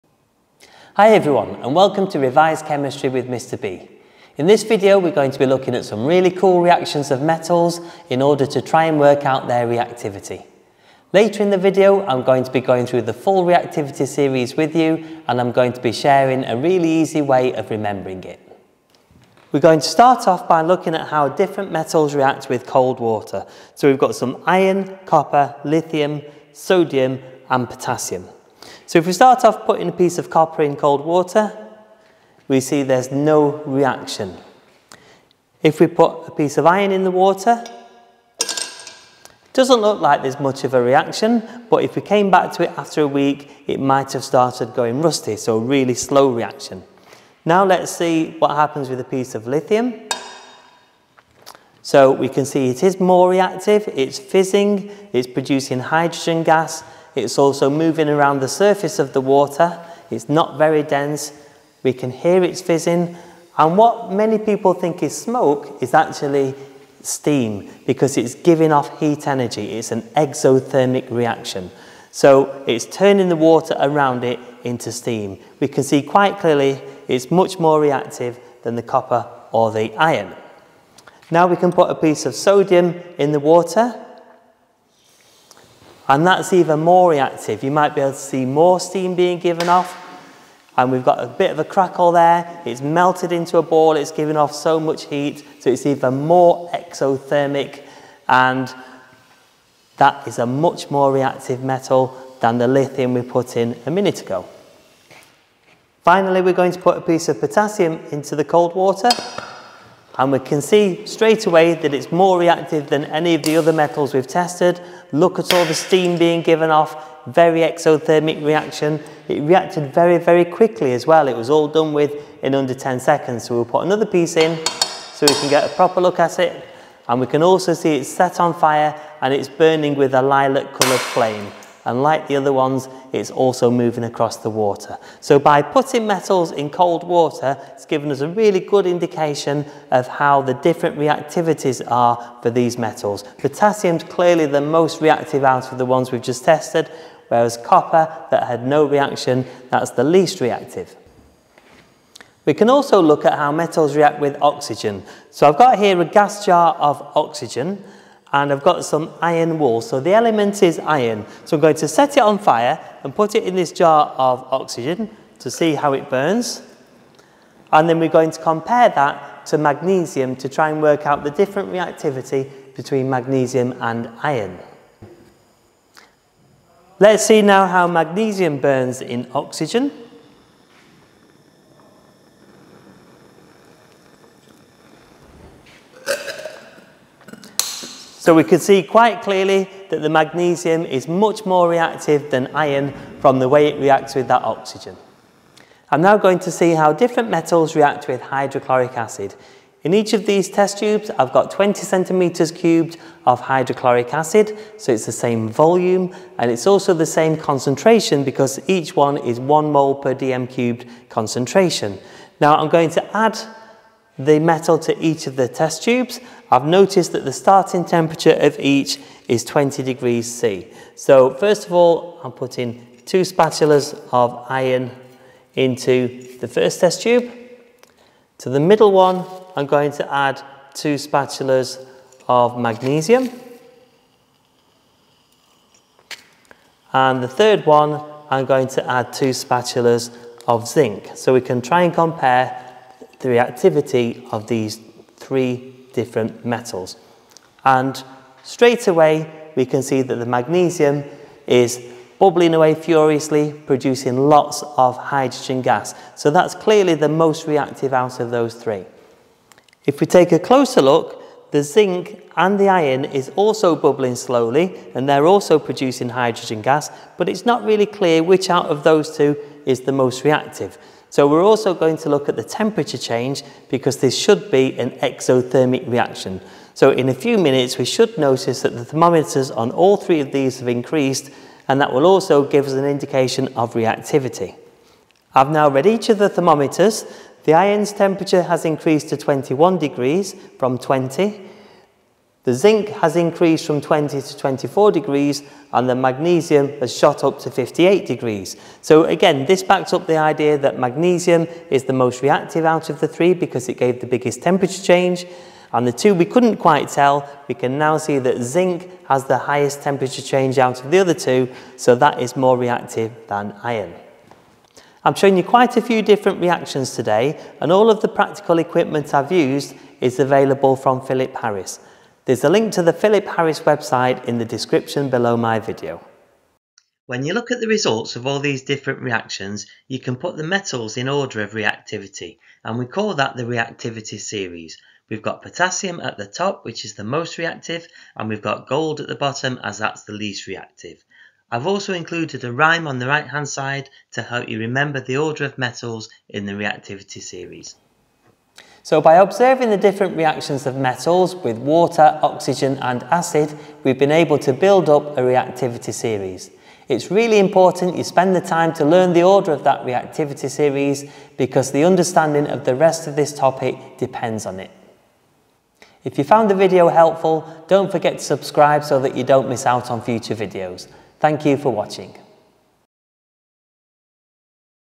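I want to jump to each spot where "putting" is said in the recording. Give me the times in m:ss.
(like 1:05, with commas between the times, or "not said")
0:29, 2:15, 3:42.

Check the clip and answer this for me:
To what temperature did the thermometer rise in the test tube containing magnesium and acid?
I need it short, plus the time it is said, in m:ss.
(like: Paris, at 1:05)
58 degrees, at 4:57.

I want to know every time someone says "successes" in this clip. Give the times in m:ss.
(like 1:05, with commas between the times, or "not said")
not said.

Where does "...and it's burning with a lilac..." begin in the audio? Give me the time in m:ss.
2:09.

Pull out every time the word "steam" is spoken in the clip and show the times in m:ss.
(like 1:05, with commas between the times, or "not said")
1:07, 1:14, 1:28, 1:55.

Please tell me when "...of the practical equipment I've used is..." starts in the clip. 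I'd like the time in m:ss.
5:17.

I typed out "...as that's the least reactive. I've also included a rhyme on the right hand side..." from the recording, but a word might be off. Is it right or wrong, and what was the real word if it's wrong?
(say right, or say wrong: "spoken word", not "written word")
right.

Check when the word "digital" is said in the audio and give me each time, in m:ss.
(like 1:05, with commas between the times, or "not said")
not said.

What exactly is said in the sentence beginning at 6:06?
If you found the video helpful, don't forget to subscribe so that you don't miss out on future videos.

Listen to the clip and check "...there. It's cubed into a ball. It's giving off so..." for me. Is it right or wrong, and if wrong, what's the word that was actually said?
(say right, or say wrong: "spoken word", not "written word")
wrong: "melted", not "cubed".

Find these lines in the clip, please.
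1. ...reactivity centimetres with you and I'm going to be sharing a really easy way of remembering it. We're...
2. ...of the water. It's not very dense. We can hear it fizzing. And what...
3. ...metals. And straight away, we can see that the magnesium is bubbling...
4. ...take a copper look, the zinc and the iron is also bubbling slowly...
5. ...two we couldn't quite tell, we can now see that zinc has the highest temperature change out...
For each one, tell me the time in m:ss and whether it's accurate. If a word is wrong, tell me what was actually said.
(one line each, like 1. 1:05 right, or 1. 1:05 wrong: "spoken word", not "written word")
1. 0:13 wrong: "series", not "centimetres"
2. 0:58 right
3. 4:06 right
4. 4:20 wrong: "closer", not "copper"
5. 5:05 right.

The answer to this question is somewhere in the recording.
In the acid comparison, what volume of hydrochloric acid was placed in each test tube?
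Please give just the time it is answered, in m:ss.
3:21.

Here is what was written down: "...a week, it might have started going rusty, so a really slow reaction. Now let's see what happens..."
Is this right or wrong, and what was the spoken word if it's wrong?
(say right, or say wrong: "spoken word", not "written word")
right.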